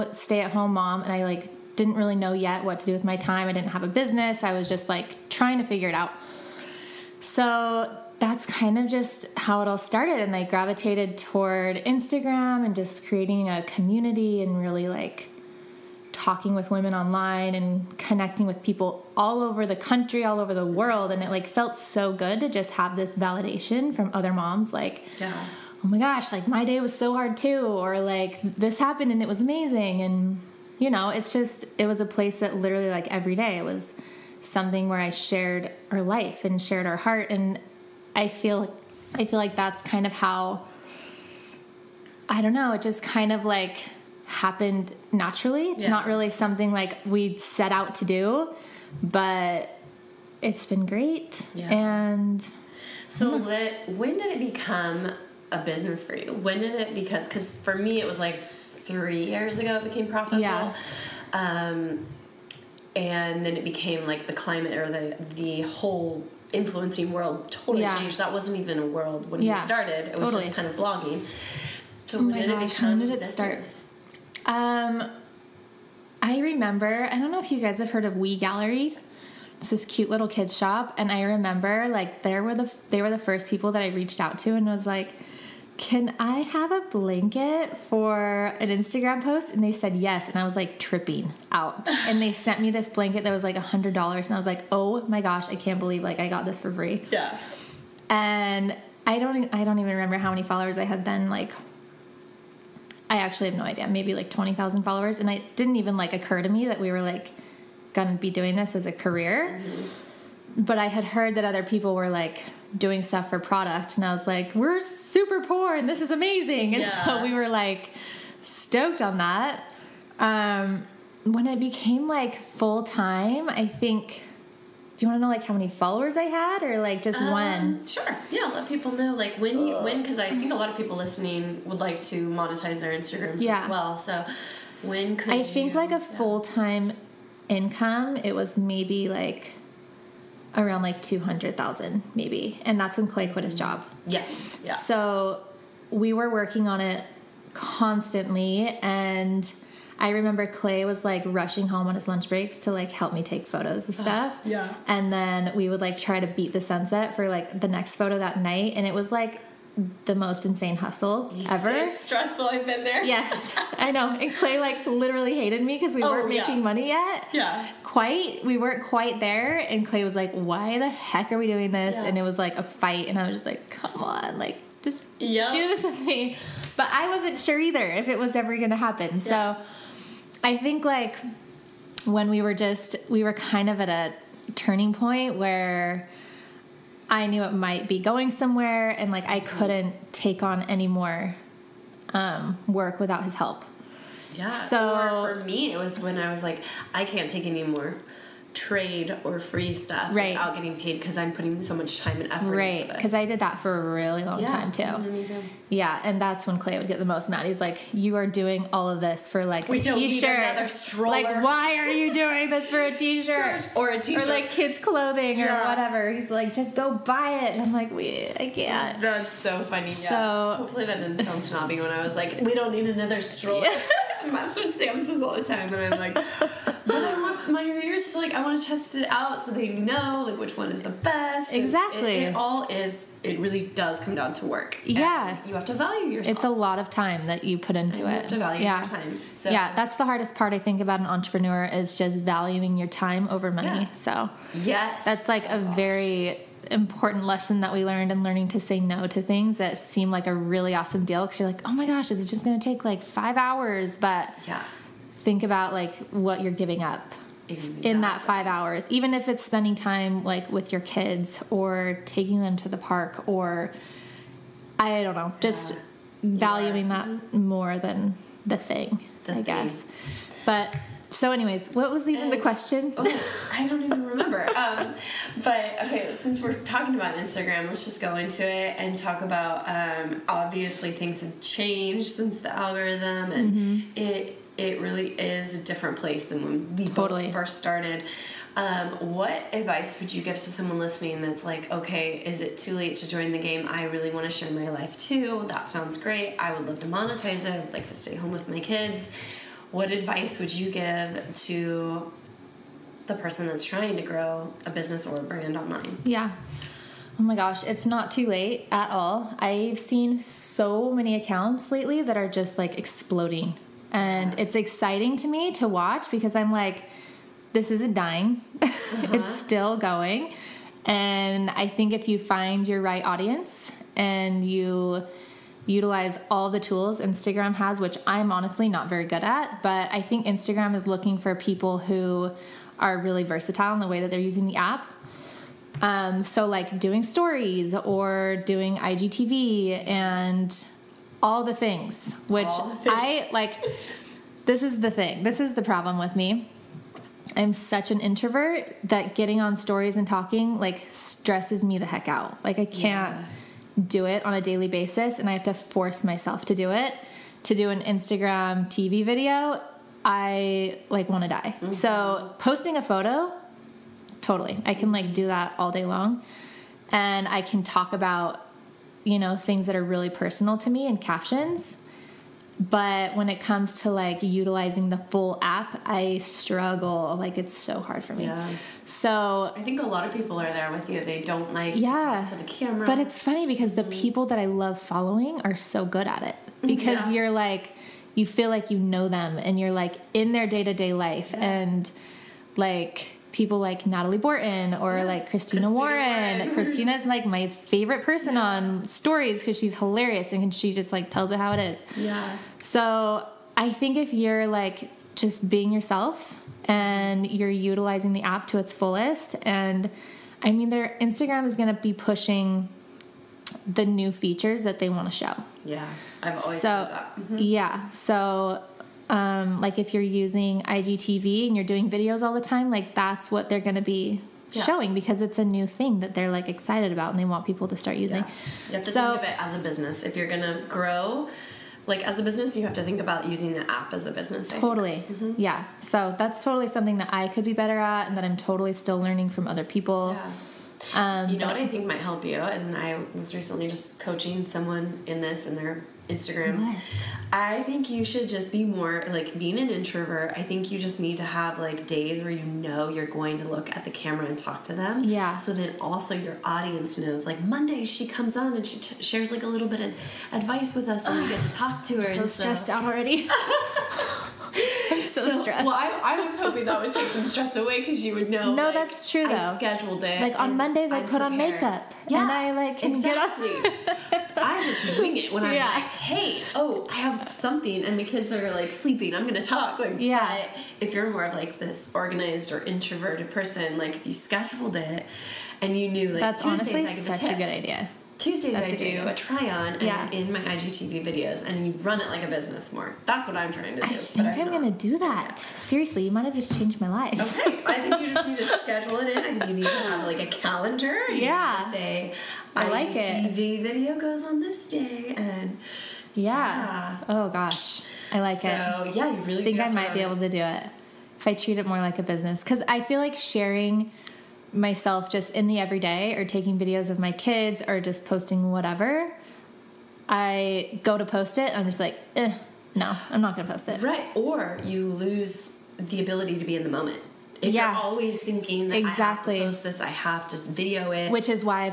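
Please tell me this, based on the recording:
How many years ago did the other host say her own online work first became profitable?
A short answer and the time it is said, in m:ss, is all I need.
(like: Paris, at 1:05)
3 years, at 0:58.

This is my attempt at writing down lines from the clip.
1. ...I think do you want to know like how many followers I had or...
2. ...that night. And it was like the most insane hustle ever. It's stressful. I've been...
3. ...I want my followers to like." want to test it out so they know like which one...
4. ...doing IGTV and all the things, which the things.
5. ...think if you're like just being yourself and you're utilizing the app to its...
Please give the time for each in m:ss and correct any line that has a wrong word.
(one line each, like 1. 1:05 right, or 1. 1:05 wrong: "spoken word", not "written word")
1. 2:03 right
2. 2:38 right
3. 3:46 wrong: "readers", not "followers"
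4. 5:38 right
5. 6:43 right.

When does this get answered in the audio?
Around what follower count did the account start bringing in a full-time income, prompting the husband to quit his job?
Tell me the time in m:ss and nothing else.
2:21.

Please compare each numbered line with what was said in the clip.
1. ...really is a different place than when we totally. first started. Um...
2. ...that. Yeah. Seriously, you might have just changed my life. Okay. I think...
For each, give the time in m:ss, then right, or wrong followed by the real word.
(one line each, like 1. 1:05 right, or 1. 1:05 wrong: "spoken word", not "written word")
1. 4:44 right
2. 8:14 right.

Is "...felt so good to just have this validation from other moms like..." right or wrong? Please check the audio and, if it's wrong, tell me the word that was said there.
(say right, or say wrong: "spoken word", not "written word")
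right.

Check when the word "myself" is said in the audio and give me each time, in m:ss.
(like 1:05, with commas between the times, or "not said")
5:56, 8:34.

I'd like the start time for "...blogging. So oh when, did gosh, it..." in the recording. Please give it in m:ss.
1:10.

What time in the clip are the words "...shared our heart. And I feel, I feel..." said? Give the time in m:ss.
0:36.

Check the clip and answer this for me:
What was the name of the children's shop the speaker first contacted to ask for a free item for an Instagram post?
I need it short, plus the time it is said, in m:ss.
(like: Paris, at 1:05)
Wee Gallery, at 1:18.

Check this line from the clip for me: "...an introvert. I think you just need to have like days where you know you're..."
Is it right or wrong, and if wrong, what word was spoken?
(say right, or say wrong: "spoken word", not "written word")
right.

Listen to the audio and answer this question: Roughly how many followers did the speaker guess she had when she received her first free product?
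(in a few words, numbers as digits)
20,000.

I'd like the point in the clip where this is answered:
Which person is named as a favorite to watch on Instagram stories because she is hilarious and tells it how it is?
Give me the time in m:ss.
6:35.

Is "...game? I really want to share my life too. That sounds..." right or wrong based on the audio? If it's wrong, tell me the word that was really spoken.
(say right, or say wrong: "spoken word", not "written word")
right.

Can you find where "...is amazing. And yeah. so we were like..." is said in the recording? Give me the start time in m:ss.
1:56.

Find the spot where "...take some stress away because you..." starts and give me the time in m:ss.
7:46.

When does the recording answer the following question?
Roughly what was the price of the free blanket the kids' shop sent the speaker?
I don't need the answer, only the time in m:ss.
1:33.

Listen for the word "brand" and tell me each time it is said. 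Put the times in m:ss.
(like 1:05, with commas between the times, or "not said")
5:05.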